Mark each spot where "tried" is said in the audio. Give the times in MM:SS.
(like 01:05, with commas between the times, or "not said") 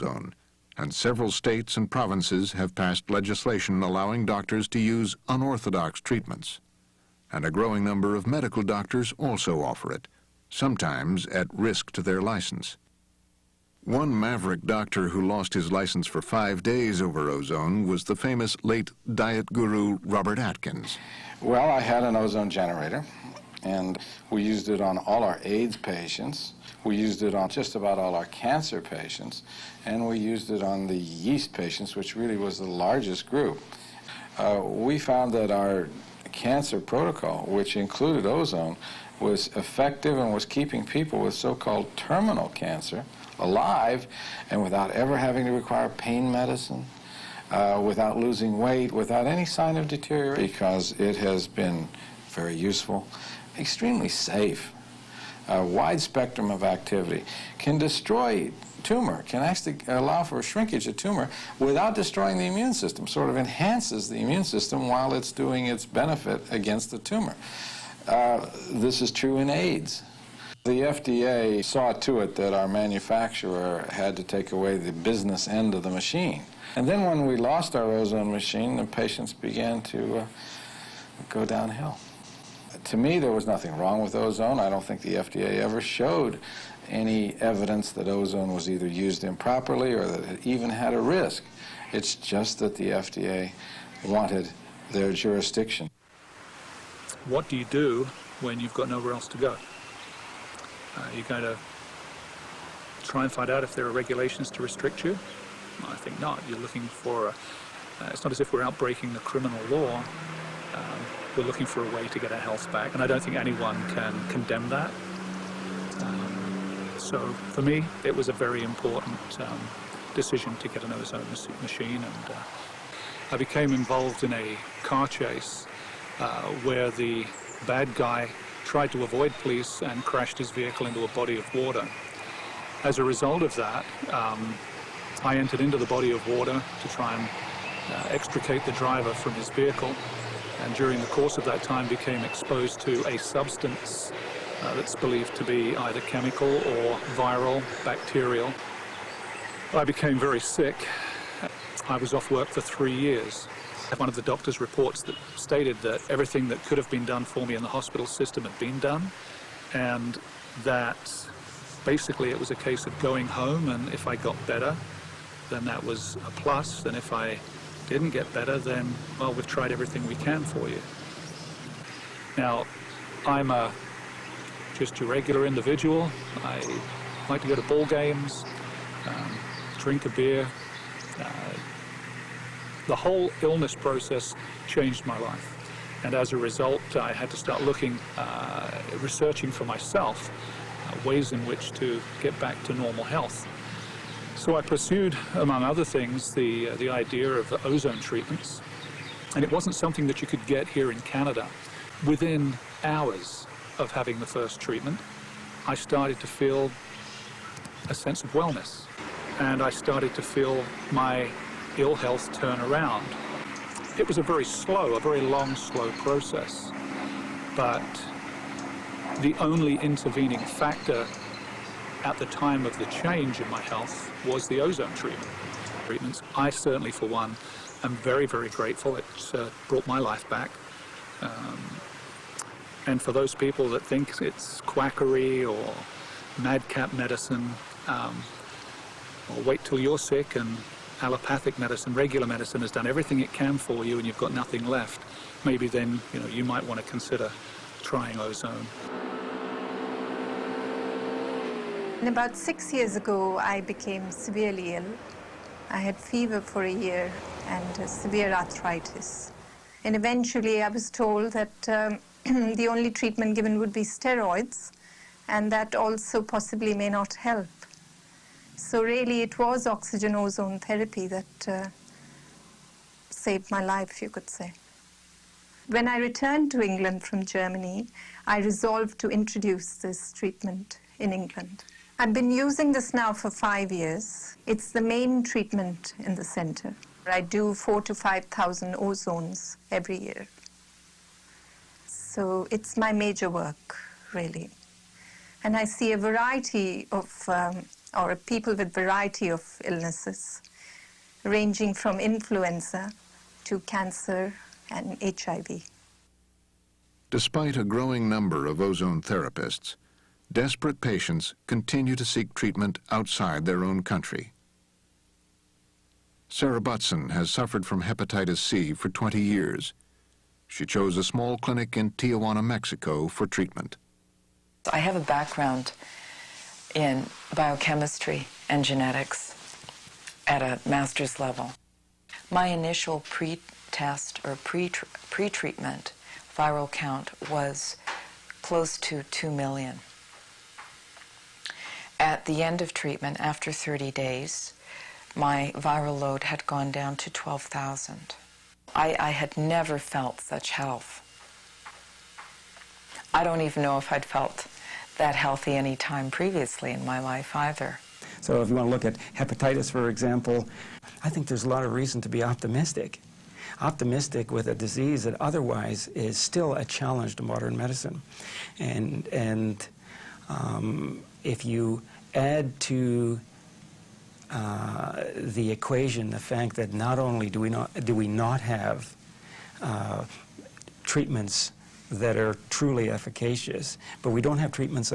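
02:08, 02:49.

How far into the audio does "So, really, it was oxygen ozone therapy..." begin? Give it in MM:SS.
04:28.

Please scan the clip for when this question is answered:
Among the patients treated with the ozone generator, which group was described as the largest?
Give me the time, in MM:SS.
00:30.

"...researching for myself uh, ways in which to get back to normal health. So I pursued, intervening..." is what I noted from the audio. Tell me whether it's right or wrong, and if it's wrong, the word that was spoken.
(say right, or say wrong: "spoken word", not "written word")
wrong: "among", not "intervening".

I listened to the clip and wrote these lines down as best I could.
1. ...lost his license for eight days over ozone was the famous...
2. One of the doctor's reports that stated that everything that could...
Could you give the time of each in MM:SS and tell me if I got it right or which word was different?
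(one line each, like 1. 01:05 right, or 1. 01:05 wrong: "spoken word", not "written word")
1. 00:15 wrong: "five", not "eight"
2. 02:33 right.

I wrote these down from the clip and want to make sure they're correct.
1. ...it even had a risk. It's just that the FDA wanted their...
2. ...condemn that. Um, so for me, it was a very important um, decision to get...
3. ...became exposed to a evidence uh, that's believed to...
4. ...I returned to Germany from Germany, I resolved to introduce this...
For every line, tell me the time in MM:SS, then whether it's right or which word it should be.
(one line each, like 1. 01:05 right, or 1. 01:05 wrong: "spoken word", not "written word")
1. 01:30 right
2. 01:54 right
3. 02:21 wrong: "substance", not "evidence"
4. 04:35 wrong: "England", not "Germany".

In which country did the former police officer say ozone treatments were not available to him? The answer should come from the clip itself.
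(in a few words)
Canada.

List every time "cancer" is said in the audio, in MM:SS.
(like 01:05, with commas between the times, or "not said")
00:28, 00:36, 00:42, 05:03.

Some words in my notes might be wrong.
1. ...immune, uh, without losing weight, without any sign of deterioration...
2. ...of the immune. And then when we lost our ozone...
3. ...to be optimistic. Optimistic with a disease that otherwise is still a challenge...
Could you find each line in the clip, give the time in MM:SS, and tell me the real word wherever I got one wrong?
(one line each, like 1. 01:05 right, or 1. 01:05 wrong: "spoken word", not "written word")
1. 00:46 wrong: "medicine", not "immune"
2. 01:15 wrong: "machine", not "immune"
3. 06:02 right.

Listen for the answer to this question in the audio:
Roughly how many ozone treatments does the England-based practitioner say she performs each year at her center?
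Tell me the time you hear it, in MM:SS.
04:47.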